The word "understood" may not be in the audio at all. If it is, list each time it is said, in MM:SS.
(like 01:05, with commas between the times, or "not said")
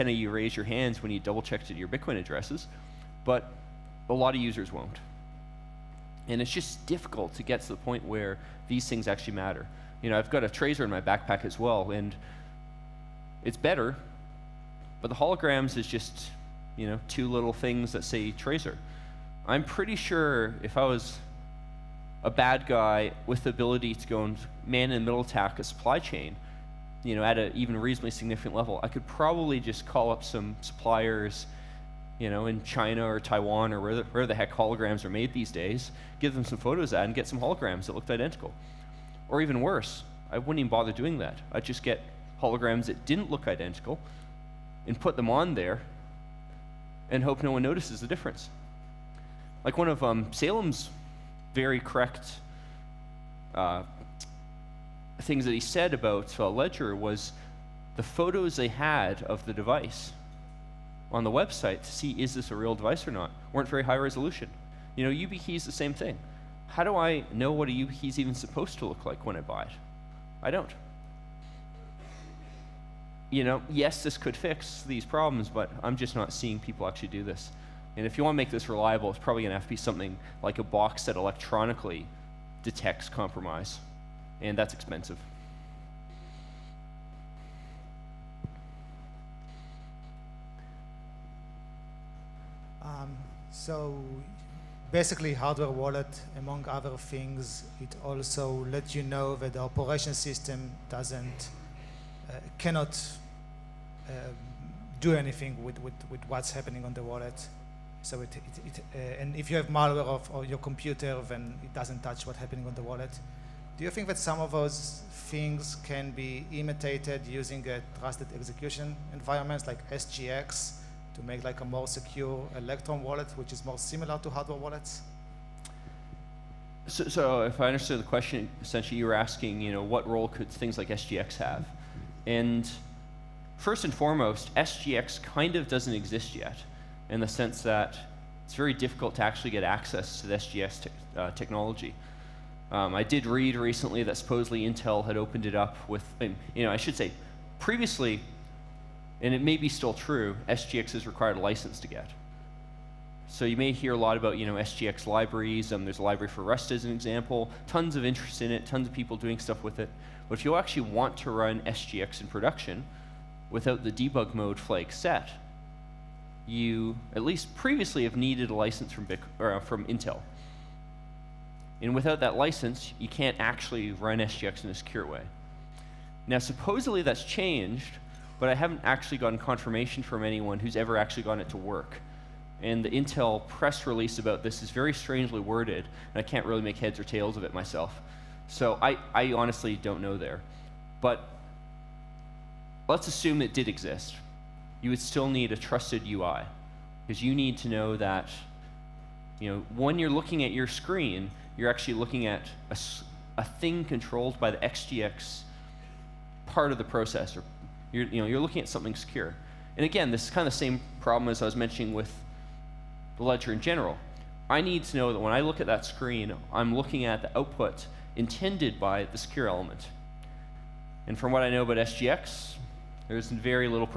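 02:07.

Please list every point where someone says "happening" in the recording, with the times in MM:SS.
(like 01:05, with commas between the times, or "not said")
01:46, 01:52.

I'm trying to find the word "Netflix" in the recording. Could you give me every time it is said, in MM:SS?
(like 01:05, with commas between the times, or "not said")
not said.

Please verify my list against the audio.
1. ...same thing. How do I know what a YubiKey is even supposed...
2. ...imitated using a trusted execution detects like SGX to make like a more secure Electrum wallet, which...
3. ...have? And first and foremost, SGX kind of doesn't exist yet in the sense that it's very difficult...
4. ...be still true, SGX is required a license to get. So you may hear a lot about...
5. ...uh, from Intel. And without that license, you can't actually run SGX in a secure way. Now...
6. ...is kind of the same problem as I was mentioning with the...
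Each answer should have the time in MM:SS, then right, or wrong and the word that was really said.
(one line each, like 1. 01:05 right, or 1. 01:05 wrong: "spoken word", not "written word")
1. 01:05 right
2. 01:56 wrong: "environments", not "detects"
3. 02:11 right
4. 02:29 right
5. 02:49 right
6. 03:30 right.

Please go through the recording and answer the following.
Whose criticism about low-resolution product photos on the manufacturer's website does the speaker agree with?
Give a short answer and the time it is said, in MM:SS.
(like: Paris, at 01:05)
Saleem, at 00:50.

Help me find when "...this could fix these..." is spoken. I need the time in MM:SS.
01:14.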